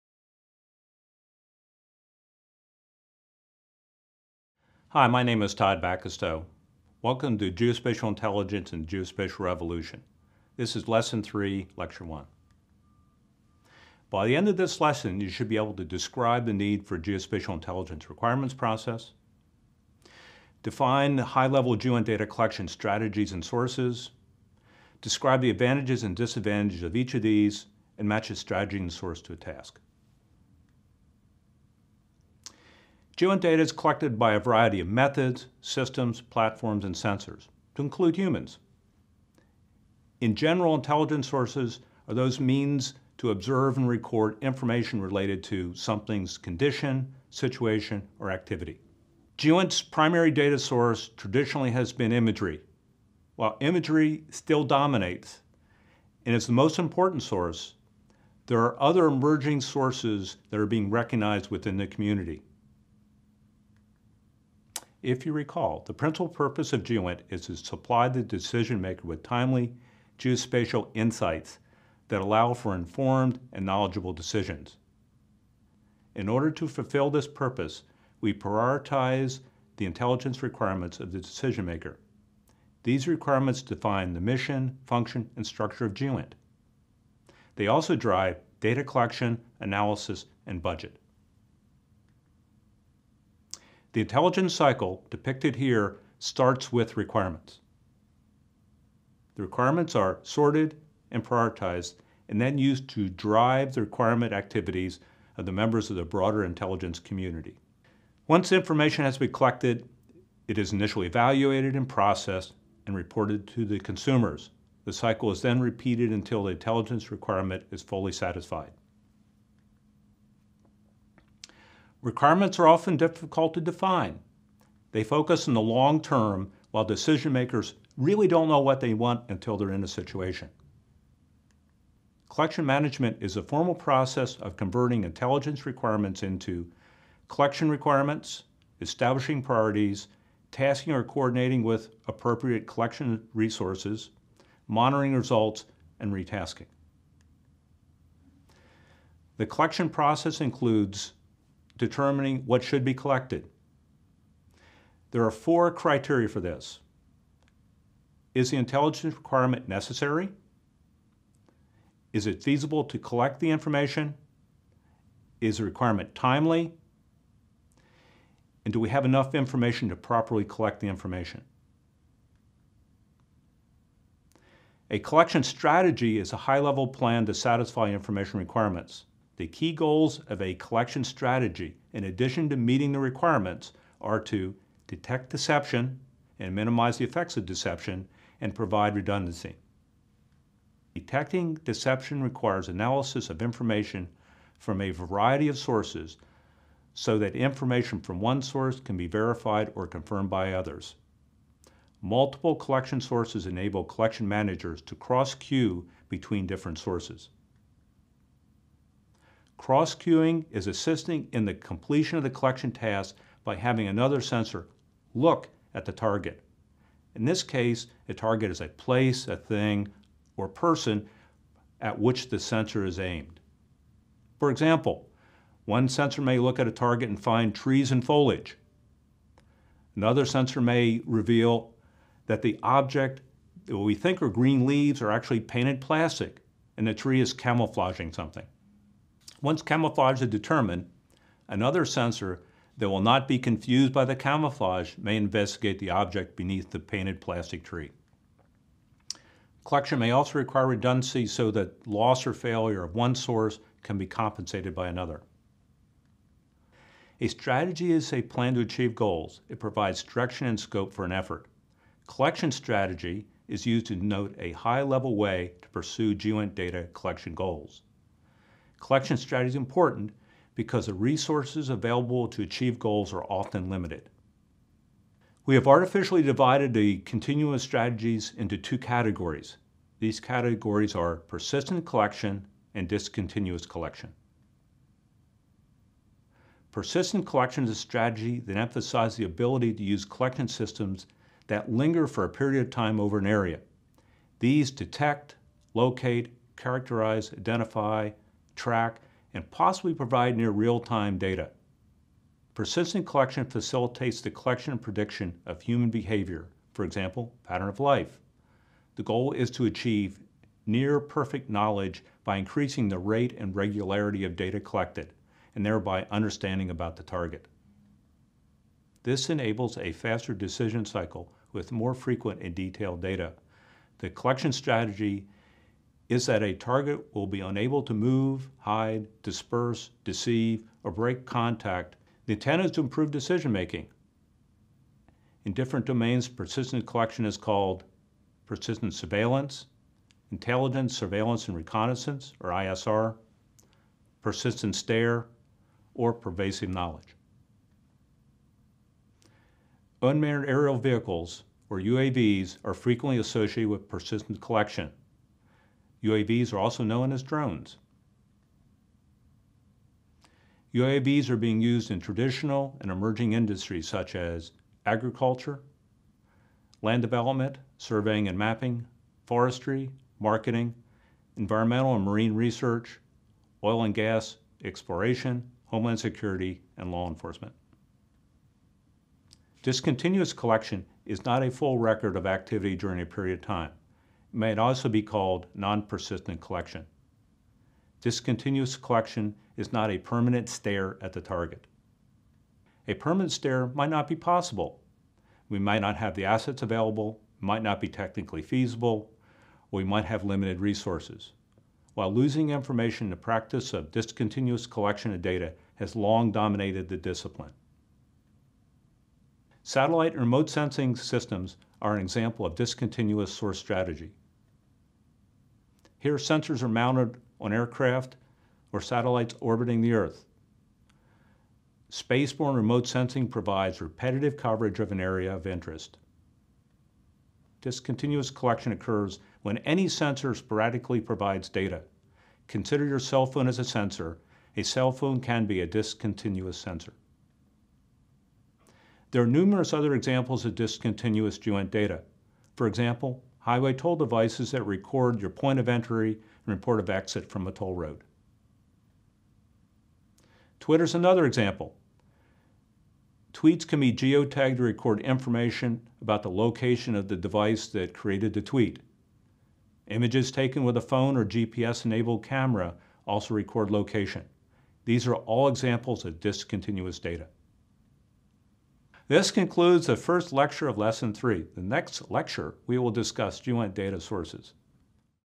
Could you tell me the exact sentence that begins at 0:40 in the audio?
In general, intelligence sources are those means to observe and record information related to something's condition, situation, or activity.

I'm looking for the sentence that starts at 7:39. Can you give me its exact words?
Images taken with a phone or GPS-enabled camera also record location.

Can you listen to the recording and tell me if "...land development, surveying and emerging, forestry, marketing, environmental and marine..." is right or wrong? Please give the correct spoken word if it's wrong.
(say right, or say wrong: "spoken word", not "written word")
wrong: "mapping", not "emerging".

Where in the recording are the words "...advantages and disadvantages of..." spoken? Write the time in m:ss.
0:25.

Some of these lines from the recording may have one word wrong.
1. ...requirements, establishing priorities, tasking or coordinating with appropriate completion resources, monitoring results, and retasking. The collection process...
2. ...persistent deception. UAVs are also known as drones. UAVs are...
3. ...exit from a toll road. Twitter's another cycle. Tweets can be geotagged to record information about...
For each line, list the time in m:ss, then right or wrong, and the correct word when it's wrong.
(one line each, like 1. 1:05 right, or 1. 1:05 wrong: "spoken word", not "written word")
1. 2:17 wrong: "collection", not "completion"
2. 5:53 wrong: "collection", not "deception"
3. 7:26 wrong: "example", not "cycle".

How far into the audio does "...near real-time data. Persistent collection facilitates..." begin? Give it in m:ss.
5:00.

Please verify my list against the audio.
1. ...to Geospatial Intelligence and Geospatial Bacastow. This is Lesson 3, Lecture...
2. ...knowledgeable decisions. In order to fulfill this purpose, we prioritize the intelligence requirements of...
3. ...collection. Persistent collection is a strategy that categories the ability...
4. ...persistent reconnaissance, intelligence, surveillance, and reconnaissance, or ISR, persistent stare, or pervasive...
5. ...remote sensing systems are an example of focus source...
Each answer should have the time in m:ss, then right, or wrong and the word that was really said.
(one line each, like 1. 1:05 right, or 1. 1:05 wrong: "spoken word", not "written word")
1. 0:07 wrong: "Revolution", not "Bacastow"
2. 1:13 right
3. 4:43 wrong: "emphasizes", not "categories"
4. 5:38 wrong: "surveillance", not "reconnaissance"
5. 6:50 wrong: "discontinuous", not "focus".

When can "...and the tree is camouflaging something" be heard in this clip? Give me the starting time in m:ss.
3:56.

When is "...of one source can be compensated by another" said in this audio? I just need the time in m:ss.
4:12.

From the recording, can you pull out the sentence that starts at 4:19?
It provides direction and scope for an effort.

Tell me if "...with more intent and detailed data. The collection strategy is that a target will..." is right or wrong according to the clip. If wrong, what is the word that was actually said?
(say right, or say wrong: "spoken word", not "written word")
wrong: "frequent", not "intent".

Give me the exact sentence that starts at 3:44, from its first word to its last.
For example, one sensor may look at a target and find trees and foliage.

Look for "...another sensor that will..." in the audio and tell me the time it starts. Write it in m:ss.
4:01.